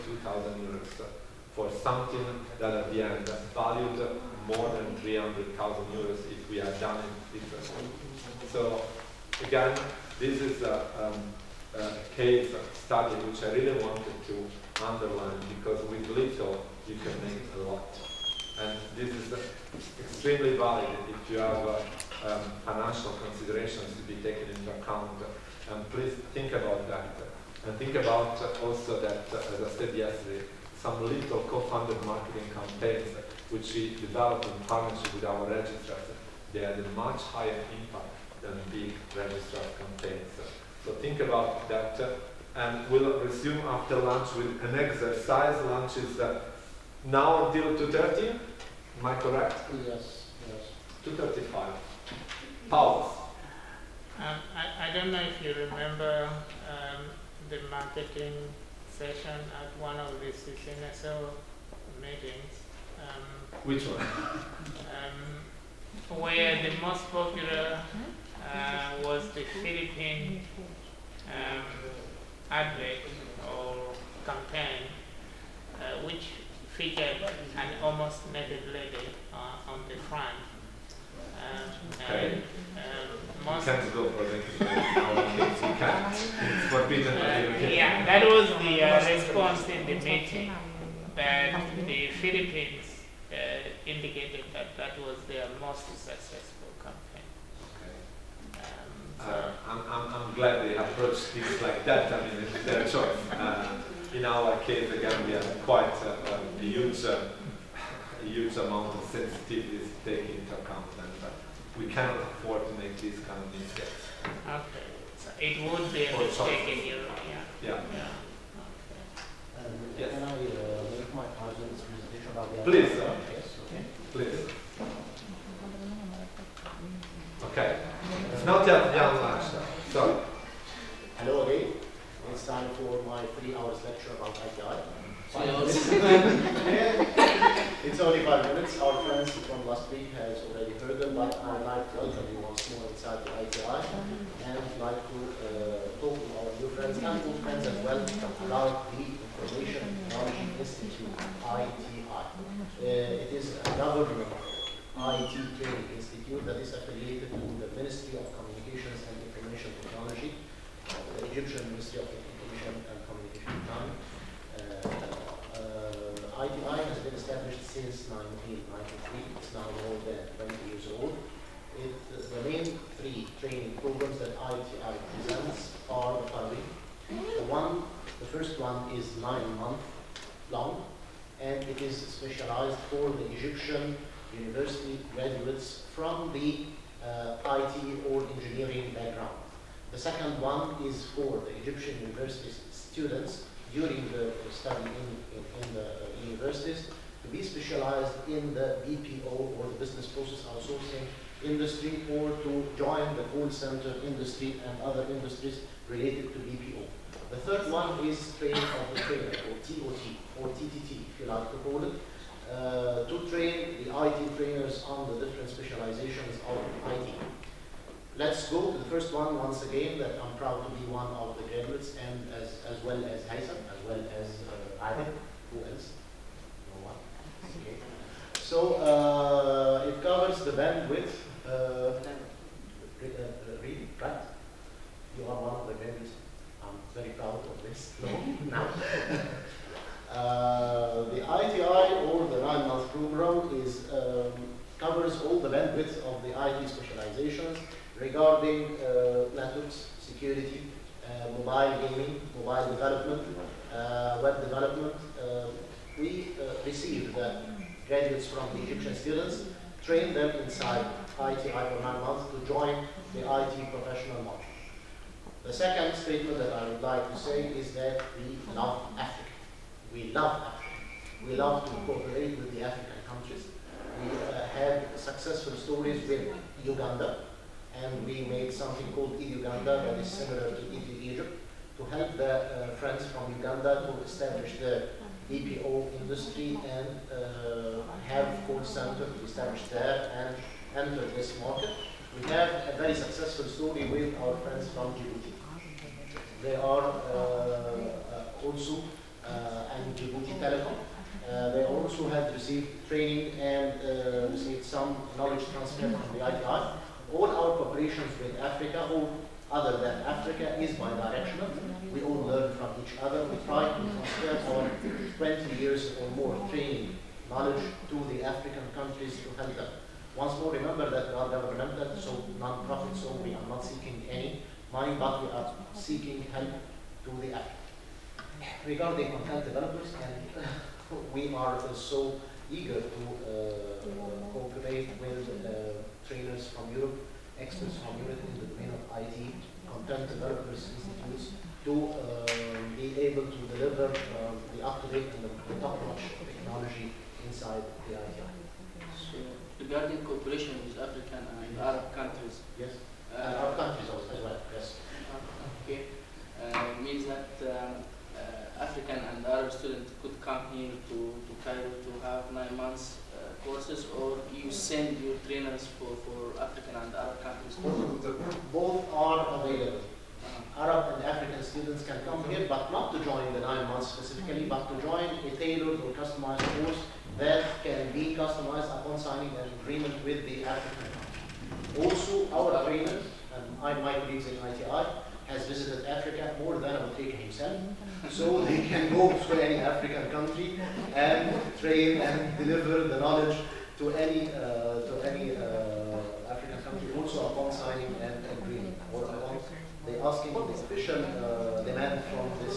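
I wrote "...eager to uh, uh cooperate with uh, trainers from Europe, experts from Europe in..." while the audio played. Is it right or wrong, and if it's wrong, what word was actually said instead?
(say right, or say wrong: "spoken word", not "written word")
right.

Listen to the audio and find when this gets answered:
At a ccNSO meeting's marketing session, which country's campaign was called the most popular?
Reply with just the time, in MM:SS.
01:09.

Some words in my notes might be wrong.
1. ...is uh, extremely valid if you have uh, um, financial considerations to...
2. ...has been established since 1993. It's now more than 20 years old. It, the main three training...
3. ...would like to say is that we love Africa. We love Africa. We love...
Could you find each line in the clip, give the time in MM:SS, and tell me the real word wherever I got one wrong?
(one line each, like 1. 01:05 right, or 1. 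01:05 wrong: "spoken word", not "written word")
1. 00:19 right
2. 02:46 right
3. 04:26 right.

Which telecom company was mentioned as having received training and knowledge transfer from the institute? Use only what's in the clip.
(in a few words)
Djibouti Telecom.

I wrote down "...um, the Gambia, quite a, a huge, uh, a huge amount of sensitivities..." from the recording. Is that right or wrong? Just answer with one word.
right.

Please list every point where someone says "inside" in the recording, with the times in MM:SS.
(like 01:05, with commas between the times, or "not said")
04:20, 05:47.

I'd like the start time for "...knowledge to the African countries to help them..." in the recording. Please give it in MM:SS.
05:17.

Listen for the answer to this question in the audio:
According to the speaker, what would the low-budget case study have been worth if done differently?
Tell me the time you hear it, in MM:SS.
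00:04.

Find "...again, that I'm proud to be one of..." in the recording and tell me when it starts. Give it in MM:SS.
03:39.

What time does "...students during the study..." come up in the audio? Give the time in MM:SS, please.
03:12.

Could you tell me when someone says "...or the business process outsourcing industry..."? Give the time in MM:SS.
03:19.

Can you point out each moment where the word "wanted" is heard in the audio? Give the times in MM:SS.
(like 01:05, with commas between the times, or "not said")
00:13.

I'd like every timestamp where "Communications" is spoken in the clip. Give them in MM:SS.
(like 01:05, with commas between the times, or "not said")
02:38, 02:43.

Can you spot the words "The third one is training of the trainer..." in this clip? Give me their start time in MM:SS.
03:27.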